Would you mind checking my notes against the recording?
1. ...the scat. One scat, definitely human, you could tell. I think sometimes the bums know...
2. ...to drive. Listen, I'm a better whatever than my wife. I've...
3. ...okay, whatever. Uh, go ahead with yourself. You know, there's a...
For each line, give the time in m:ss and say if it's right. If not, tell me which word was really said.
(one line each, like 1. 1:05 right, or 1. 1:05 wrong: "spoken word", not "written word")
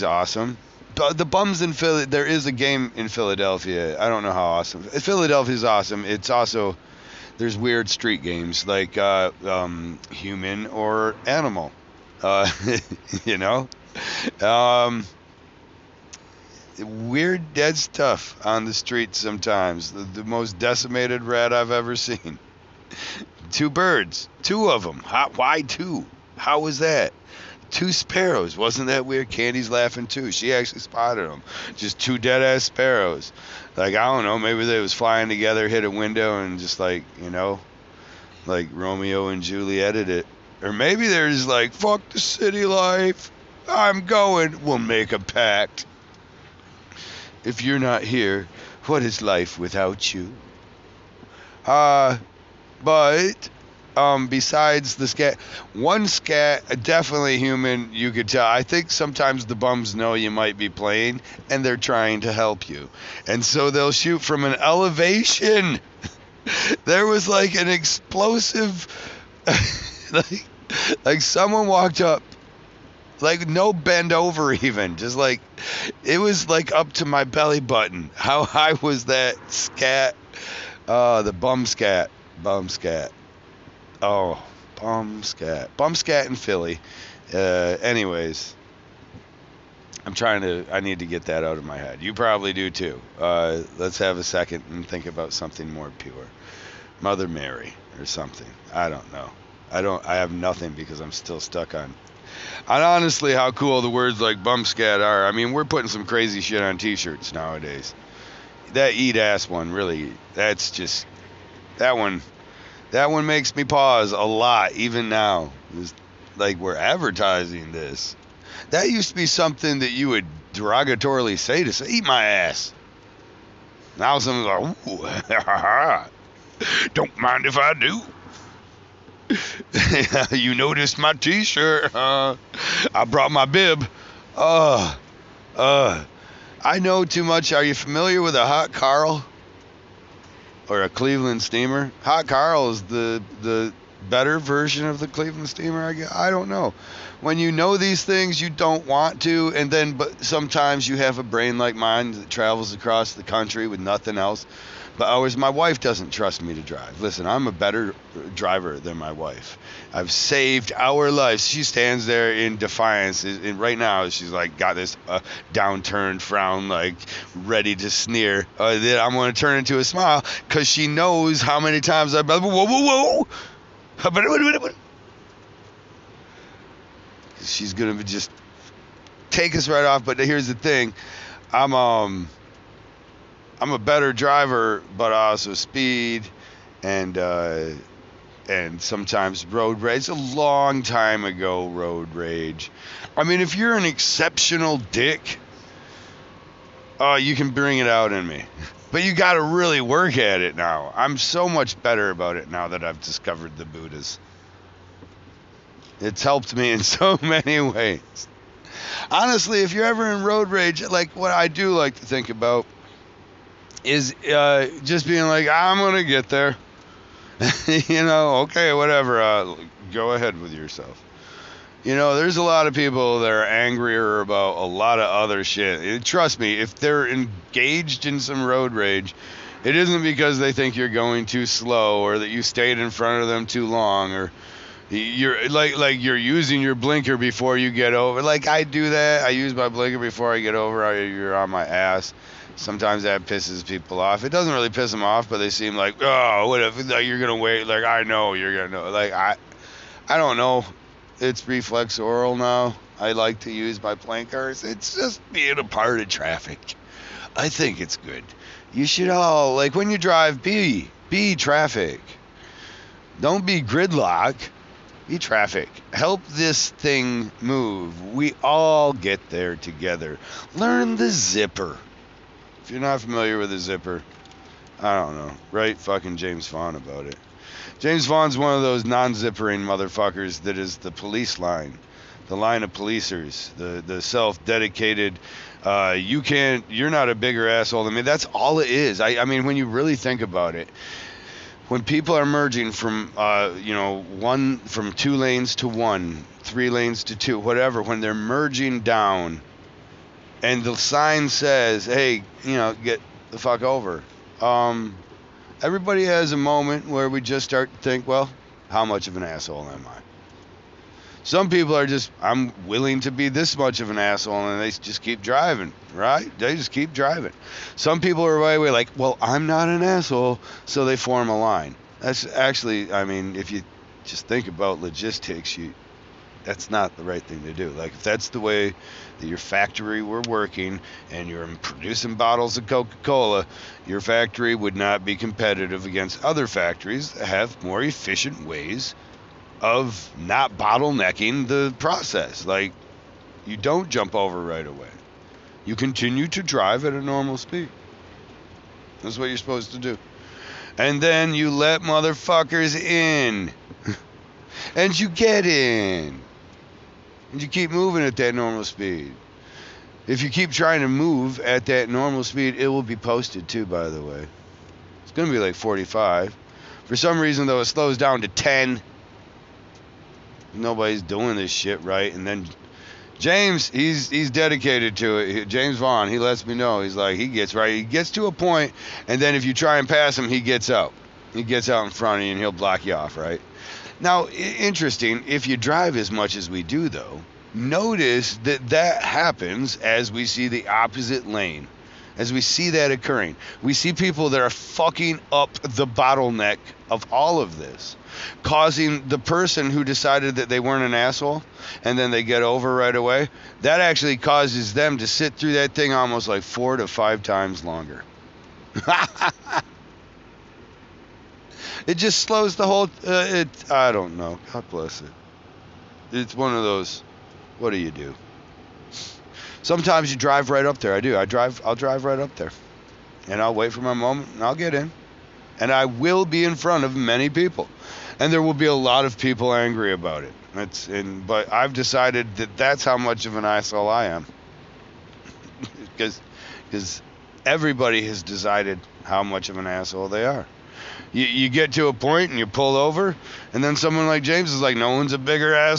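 1. 0:54 right
2. 2:36 wrong: "driver", not "whatever"
3. 3:38 right.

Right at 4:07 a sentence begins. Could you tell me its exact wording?
Like I know you're gonna know.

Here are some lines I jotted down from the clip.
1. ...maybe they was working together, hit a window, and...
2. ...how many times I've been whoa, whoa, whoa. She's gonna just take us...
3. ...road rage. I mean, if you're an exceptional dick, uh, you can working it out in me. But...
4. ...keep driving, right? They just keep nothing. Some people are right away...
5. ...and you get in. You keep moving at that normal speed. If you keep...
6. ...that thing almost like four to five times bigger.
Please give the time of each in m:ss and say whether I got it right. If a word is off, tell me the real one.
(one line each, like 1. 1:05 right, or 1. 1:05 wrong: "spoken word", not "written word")
1. 0:34 wrong: "flying", not "working"
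2. 2:51 right
3. 3:11 wrong: "bring", not "working"
4. 5:15 wrong: "driving", not "nothing"
5. 5:54 right
6. 6:45 wrong: "longer", not "bigger".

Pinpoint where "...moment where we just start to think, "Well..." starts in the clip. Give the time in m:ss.
5:06.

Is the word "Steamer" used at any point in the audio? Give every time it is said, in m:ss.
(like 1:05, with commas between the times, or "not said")
2:21, 2:25.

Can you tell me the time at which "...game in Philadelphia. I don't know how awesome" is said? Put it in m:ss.
0:02.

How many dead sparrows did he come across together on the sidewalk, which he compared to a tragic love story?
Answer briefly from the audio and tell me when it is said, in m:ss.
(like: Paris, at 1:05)
2, at 0:27.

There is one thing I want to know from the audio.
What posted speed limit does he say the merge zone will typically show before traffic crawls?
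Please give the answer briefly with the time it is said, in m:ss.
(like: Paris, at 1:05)
45, at 6:05.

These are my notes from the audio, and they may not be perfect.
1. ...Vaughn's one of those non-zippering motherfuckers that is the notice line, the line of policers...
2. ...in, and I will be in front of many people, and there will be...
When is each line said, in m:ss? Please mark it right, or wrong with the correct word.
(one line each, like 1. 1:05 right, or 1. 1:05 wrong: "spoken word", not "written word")
1. 4:38 wrong: "police", not "notice"
2. 7:04 right.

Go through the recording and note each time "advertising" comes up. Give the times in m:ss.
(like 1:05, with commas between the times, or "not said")
1:56.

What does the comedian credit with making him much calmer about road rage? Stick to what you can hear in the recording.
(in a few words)
the Buddhas.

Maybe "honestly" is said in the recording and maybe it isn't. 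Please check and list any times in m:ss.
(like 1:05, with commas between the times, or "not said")
1:42, 3:29.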